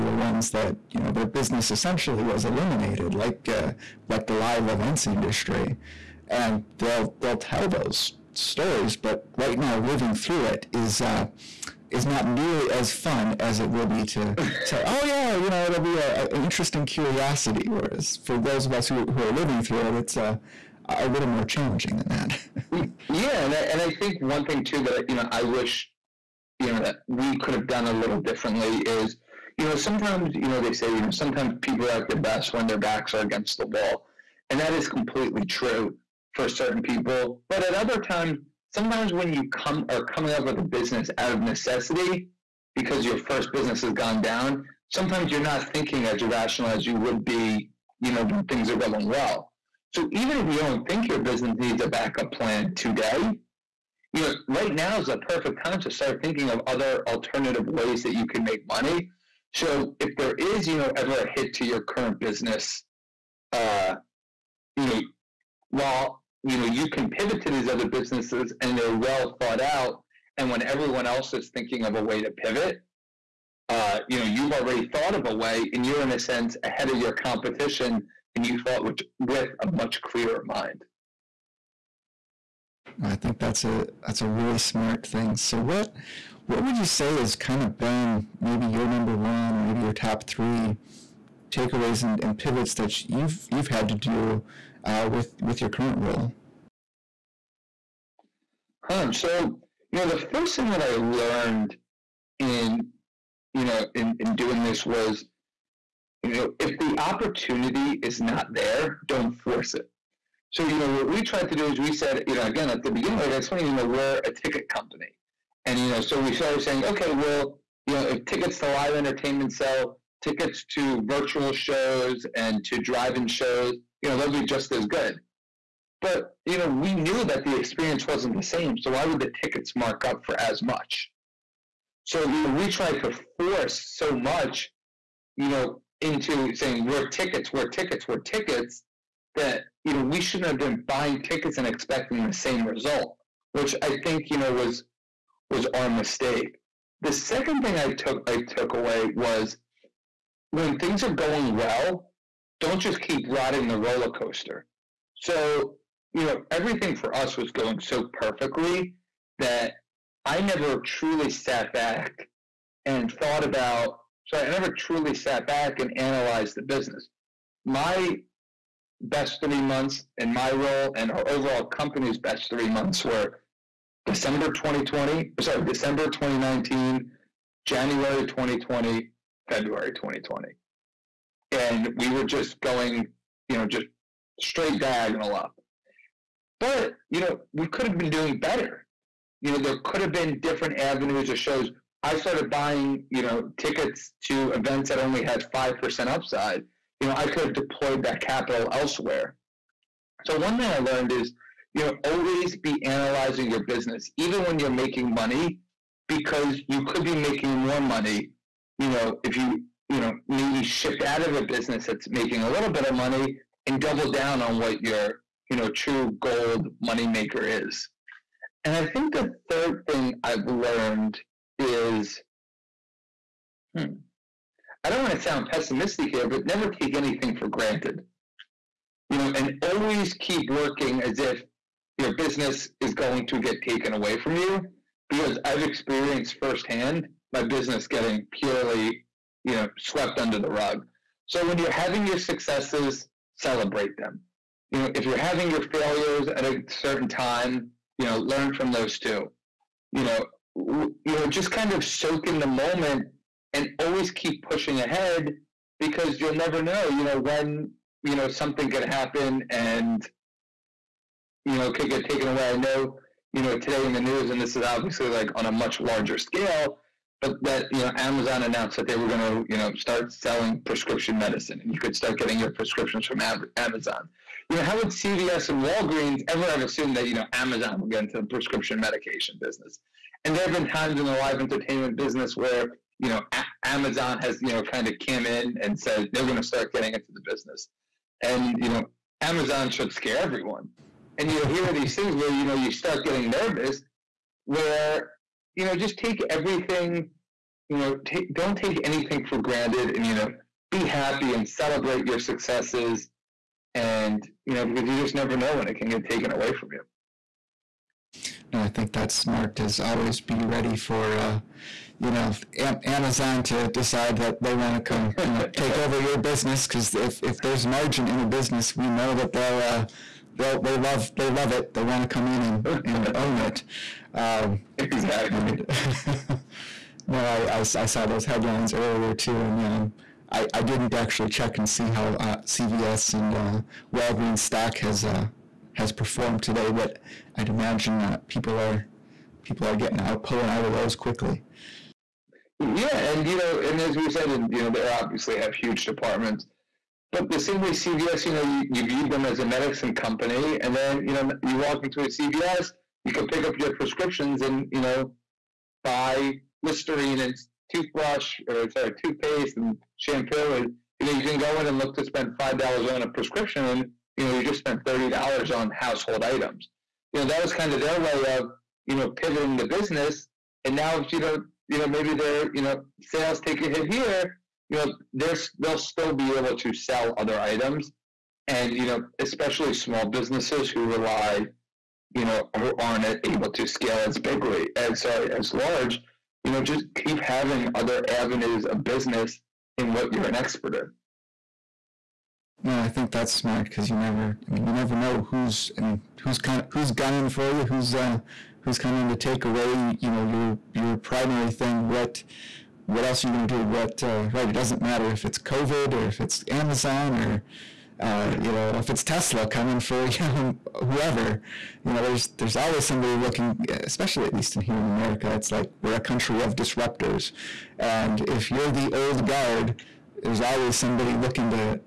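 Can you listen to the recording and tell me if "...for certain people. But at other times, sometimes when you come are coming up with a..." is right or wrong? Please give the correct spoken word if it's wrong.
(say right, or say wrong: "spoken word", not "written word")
right.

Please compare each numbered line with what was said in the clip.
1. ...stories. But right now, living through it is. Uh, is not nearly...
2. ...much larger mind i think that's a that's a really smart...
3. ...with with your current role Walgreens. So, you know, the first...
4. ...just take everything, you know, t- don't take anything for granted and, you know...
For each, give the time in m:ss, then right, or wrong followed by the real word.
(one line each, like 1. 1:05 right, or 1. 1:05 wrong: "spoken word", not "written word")
1. 0:08 right
2. 1:19 wrong: "clearer", not "larger"
3. 1:35 wrong: "Huh", not "Walgreens"
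4. 4:55 right.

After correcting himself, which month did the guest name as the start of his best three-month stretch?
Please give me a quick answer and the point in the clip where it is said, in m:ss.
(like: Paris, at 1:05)
December 2019, at 2:55.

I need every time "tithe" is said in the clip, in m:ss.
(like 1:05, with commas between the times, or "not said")
not said.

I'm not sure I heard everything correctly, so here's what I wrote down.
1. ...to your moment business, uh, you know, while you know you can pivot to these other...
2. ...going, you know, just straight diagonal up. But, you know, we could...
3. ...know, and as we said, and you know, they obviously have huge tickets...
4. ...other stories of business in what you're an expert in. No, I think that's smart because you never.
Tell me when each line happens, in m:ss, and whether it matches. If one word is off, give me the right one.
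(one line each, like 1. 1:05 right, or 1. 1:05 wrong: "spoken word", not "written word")
1. 1:01 wrong: "current", not "moment"
2. 3:02 right
3. 5:43 wrong: "departments", not "tickets"
4. 6:27 wrong: "avenues", not "stories".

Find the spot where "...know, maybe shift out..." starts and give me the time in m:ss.
3:30.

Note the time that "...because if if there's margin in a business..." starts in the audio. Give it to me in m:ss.
5:16.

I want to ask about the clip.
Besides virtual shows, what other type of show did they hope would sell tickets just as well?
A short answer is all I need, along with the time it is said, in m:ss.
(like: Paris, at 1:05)
drive in shows, at 2:02.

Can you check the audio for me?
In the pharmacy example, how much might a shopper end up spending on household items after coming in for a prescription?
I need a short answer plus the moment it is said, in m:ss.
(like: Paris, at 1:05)
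$30, at 6:04.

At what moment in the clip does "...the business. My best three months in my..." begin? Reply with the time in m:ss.
2:46.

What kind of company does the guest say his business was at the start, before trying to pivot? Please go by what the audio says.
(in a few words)
ticket company.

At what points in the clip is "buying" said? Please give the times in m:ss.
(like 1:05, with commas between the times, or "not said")
2:20, 3:12.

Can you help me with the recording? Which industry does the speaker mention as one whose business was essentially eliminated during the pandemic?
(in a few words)
live events industry.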